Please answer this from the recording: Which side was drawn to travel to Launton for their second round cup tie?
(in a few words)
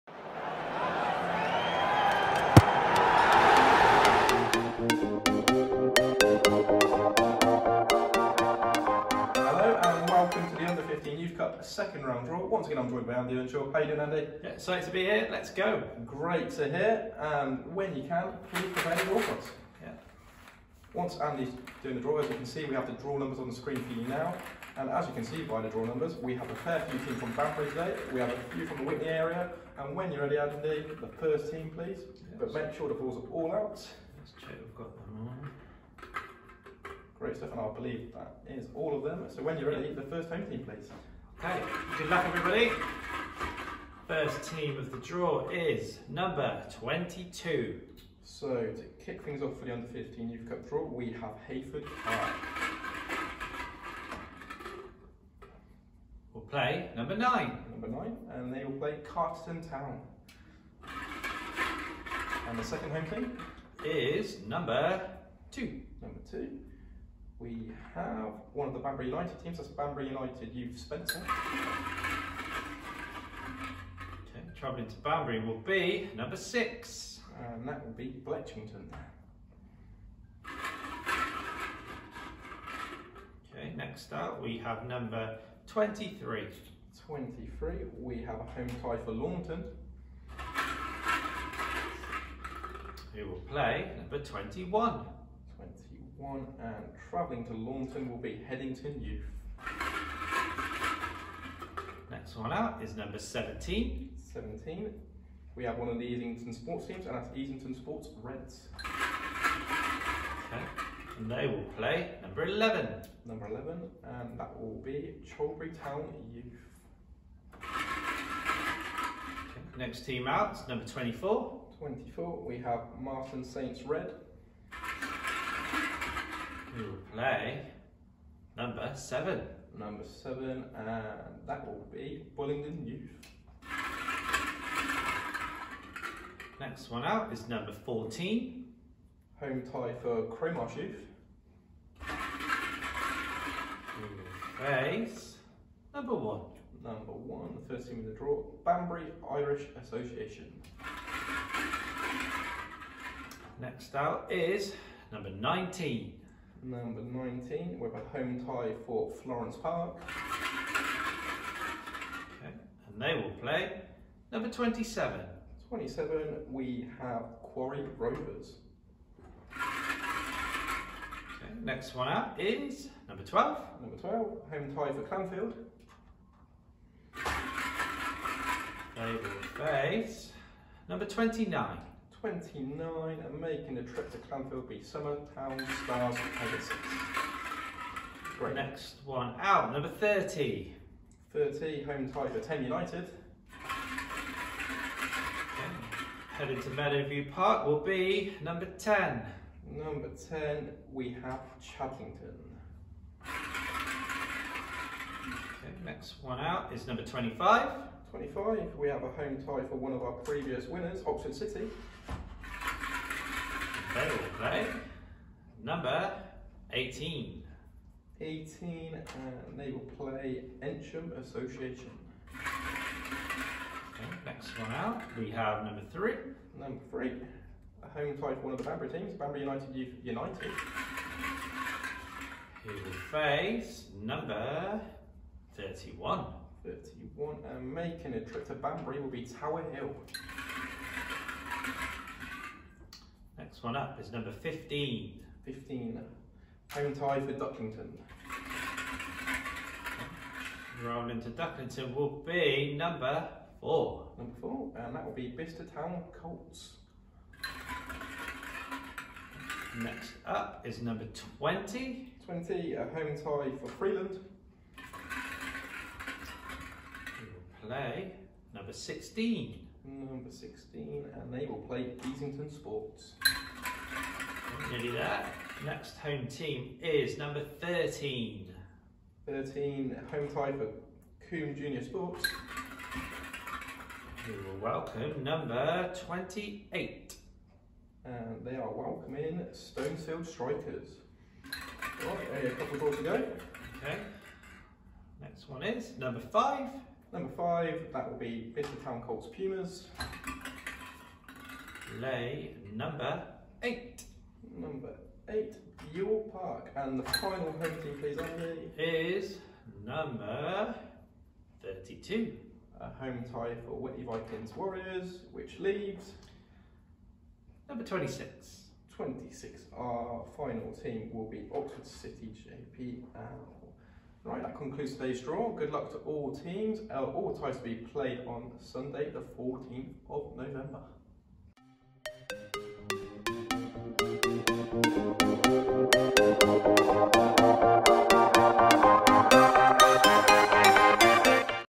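Headington Youth.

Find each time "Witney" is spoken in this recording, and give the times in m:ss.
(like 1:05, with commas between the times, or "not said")
0:28, 5:13.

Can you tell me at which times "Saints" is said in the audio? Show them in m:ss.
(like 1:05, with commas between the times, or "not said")
2:03.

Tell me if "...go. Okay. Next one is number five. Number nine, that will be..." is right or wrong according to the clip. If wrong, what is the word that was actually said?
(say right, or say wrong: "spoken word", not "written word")
wrong: "five", not "nine".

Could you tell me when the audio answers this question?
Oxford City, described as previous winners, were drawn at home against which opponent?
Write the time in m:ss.
3:40.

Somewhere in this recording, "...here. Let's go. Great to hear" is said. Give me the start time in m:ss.
0:15.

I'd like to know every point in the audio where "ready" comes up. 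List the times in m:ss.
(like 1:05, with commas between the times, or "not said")
0:30, 0:39.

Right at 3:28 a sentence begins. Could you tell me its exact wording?
25, we have a home tie for one of our previous winners, Oxford City.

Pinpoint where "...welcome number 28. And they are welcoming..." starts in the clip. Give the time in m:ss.
4:44.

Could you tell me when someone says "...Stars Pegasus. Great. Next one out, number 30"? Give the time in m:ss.
3:05.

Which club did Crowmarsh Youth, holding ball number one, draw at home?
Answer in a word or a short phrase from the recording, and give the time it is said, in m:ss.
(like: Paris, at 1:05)
Banbury Irish Association, at 2:28.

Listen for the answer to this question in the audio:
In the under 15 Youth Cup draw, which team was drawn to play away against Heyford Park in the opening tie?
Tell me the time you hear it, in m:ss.
0:59.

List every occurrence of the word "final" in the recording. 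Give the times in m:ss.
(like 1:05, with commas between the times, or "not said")
5:07, 5:20.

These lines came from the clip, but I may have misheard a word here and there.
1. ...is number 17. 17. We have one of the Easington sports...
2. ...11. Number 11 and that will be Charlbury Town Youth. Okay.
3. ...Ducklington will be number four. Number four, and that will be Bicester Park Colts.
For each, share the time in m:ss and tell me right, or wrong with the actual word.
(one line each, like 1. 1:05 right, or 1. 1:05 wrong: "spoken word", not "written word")
1. 1:42 right
2. 1:52 right
3. 4:11 wrong: "Town", not "Park".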